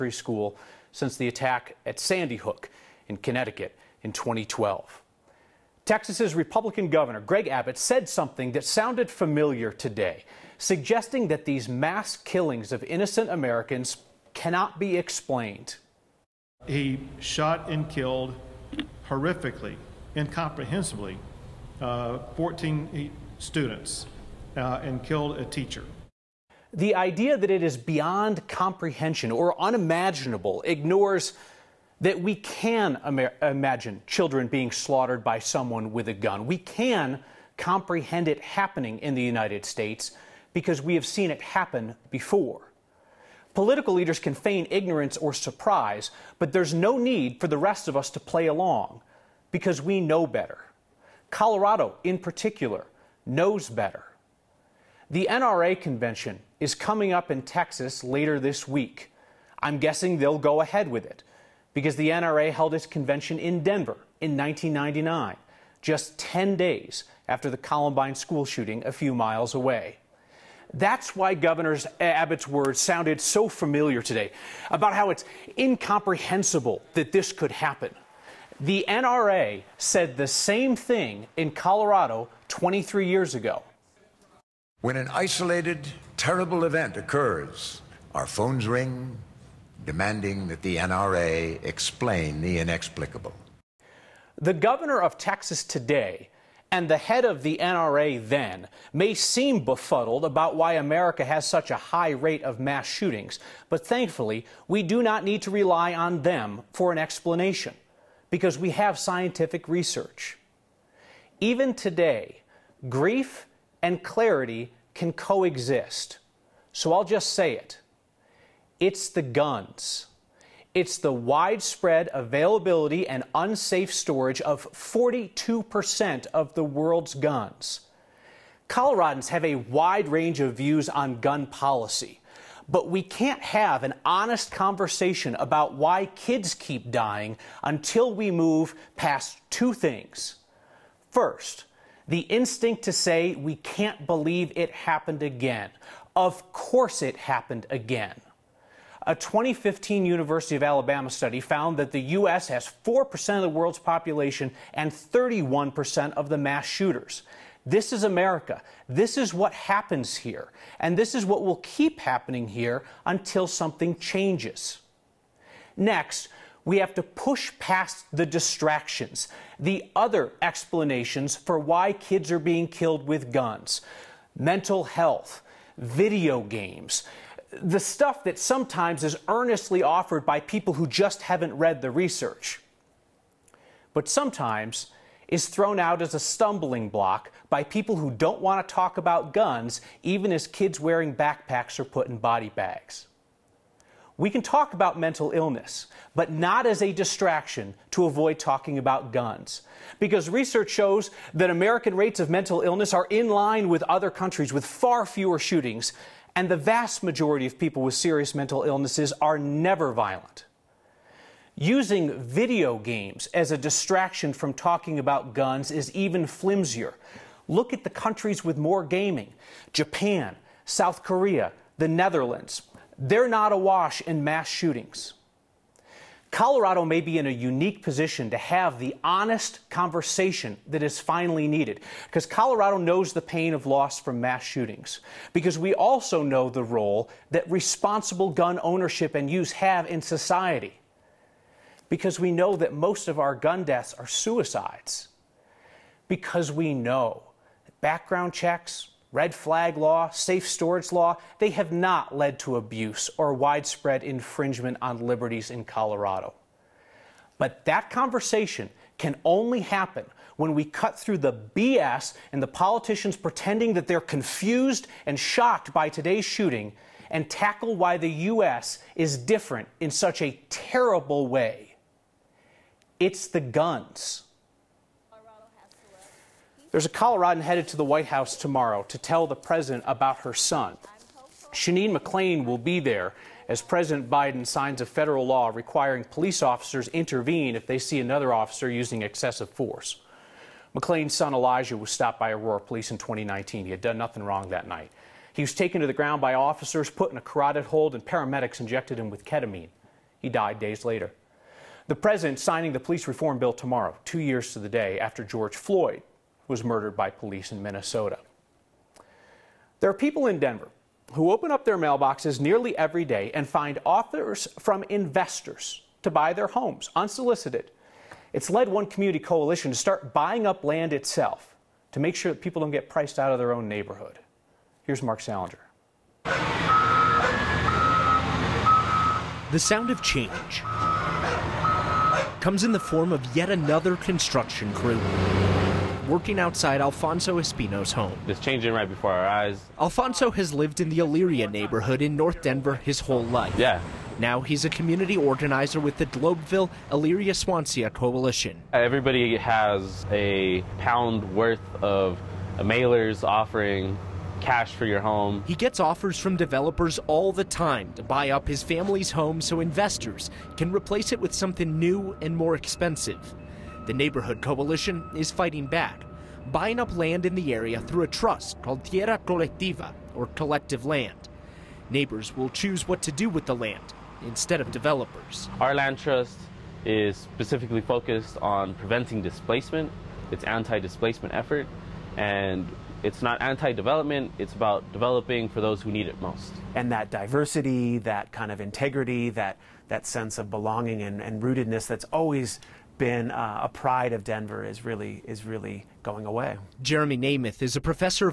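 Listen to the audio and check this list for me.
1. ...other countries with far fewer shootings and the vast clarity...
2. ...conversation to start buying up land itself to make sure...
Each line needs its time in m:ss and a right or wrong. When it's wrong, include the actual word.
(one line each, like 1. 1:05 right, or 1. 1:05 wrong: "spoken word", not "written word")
1. 3:23 wrong: "majority", not "clarity"
2. 5:19 wrong: "coalition", not "conversation".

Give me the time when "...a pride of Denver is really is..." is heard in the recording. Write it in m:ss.
6:33.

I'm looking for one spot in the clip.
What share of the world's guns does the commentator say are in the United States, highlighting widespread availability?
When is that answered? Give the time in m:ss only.
2:04.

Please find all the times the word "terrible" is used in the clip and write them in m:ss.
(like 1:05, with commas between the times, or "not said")
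1:26, 4:30.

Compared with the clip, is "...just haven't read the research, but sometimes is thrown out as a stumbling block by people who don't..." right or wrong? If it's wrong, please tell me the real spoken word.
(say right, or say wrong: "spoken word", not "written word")
right.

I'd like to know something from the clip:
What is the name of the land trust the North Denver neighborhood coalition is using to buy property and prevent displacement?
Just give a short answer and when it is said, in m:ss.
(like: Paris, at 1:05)
Tierra Colectiva, at 6:08.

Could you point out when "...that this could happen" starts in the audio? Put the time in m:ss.
1:16.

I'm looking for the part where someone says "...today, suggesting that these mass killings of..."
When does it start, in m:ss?
0:09.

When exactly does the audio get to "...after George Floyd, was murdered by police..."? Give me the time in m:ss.
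5:04.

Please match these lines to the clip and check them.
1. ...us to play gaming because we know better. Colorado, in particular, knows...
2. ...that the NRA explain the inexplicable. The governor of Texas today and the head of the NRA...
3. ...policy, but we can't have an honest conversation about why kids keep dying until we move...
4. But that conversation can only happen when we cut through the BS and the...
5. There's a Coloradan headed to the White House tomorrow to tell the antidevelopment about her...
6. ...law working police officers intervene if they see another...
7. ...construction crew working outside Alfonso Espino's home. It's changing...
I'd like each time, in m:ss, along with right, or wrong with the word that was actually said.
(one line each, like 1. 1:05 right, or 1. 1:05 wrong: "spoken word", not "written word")
1. 0:47 wrong: "along", not "gaming"
2. 1:30 right
3. 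2:11 right
4. 4:17 right
5. 4:36 wrong: "president", not "antidevelopment"
6. 4:45 wrong: "requiring", not "working"
7. 5:33 right.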